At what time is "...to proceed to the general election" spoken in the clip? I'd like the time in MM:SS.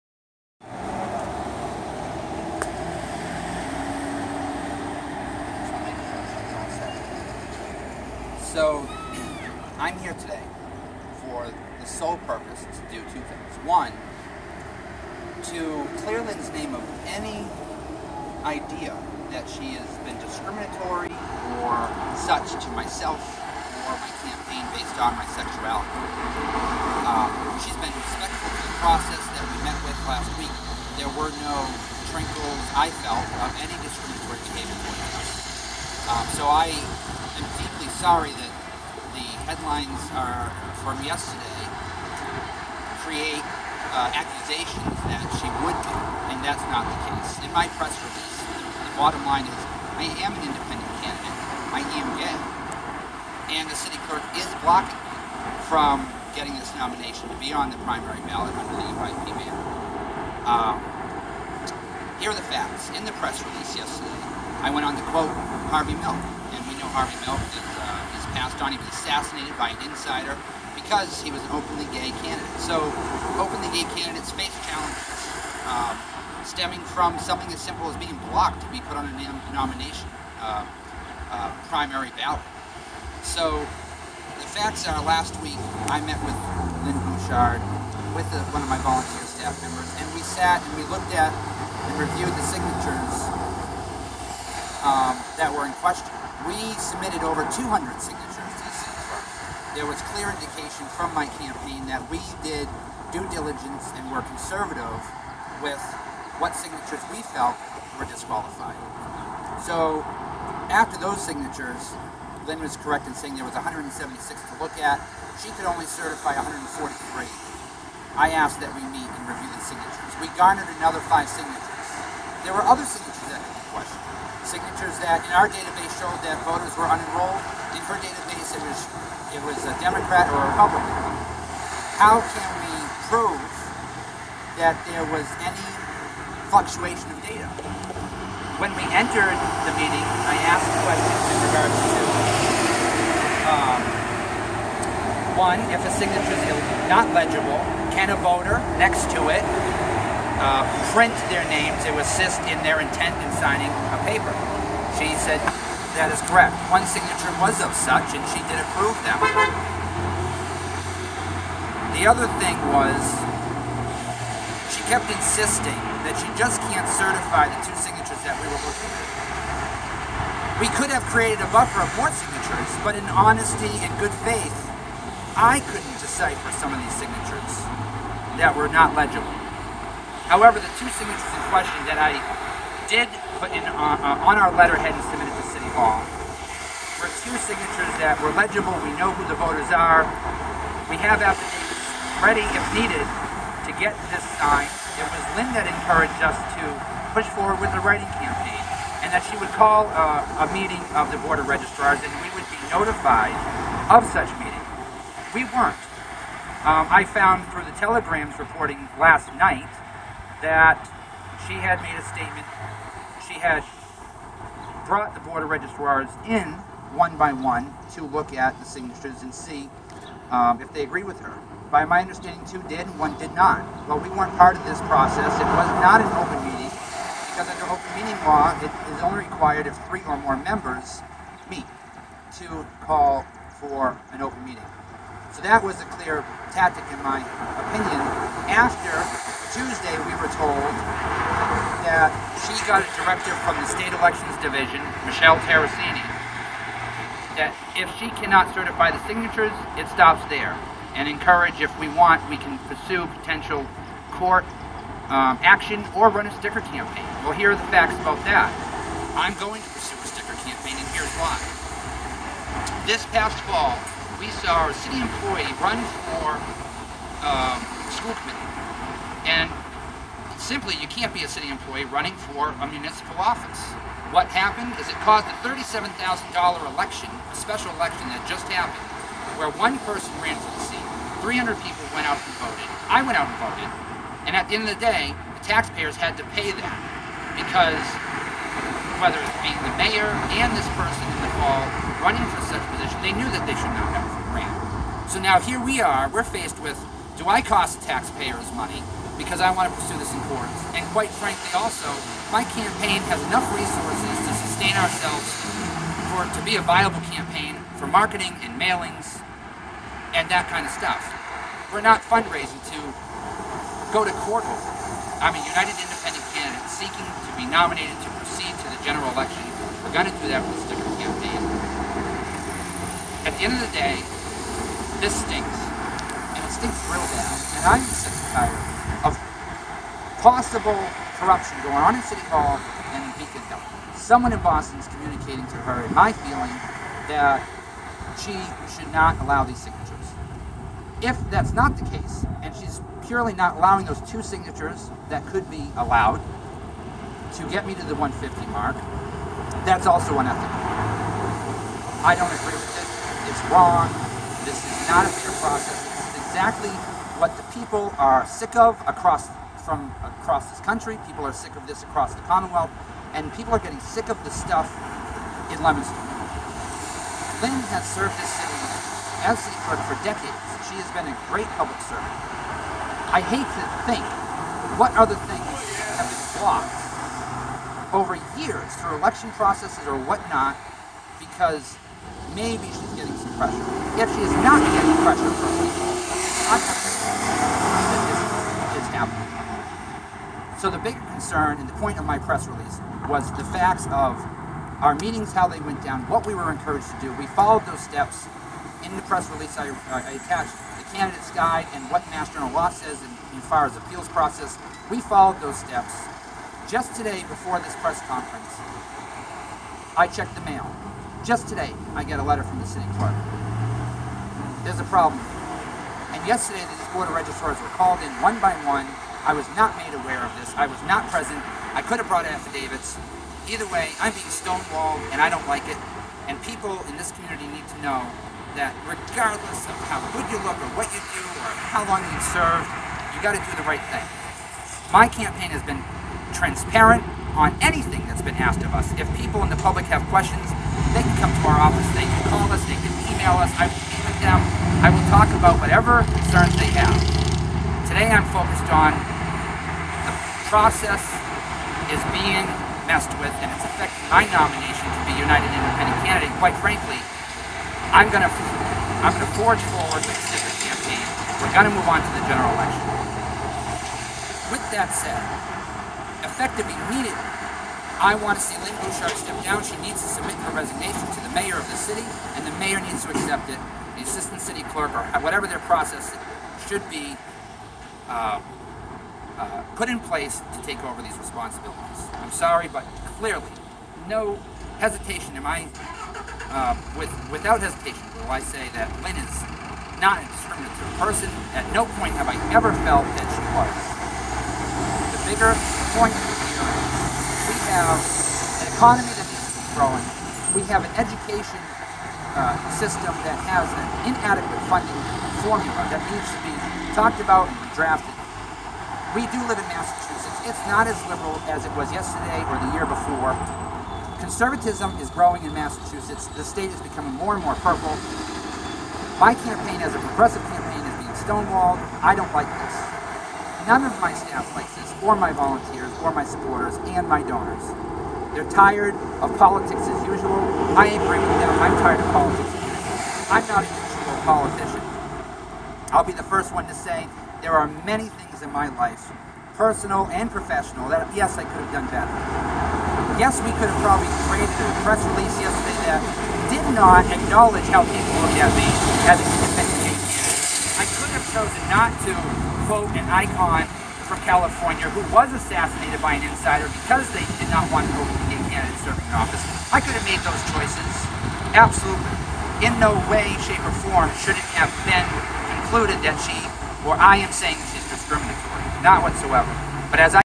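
05:18.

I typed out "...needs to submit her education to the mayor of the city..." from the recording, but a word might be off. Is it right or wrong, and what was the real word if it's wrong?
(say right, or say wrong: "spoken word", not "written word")
wrong: "resignation", not "education".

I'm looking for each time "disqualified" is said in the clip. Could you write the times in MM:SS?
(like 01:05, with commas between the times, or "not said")
01:48.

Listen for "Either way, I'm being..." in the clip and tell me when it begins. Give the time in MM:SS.
07:03.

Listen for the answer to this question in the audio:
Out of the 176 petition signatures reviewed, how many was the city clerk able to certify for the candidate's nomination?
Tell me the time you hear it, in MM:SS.
01:56.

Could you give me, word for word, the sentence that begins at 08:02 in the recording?
I'm sorry, but clearly, no hesitation am I, uh, with, without hesitation will I say that Lynn is not a discriminatory person.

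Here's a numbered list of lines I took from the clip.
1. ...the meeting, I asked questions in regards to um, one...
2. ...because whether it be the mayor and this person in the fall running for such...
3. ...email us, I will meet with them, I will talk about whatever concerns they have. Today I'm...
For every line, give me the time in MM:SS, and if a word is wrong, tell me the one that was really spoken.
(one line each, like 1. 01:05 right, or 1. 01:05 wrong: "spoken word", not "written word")
1. 02:19 right
2. 04:47 right
3. 07:23 right.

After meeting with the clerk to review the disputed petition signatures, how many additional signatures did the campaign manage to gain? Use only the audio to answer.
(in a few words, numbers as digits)
5.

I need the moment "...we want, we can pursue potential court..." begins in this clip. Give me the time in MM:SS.
04:11.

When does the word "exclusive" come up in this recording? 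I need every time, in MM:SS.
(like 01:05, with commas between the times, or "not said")
not said.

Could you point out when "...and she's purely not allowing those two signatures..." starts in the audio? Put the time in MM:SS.
05:42.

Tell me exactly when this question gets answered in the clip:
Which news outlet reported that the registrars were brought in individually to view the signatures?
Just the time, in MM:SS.
03:27.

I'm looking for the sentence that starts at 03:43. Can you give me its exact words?
Well, we weren't part of this process.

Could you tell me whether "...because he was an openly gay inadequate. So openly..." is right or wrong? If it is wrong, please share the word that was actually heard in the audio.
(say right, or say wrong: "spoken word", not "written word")
wrong: "candidate", not "inadequate".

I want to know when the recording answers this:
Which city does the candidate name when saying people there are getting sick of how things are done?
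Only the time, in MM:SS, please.
06:05.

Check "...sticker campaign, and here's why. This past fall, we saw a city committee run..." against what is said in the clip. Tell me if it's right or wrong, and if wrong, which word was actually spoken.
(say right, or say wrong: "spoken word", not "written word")
wrong: "employee", not "committee".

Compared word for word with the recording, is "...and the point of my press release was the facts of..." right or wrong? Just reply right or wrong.
right.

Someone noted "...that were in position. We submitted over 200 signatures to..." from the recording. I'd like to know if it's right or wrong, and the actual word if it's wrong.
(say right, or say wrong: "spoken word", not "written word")
wrong: "question", not "position".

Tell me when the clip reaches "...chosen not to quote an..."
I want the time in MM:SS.
09:11.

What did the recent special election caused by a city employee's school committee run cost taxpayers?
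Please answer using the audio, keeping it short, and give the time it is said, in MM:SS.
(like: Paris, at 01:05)
$37,000, at 04:35.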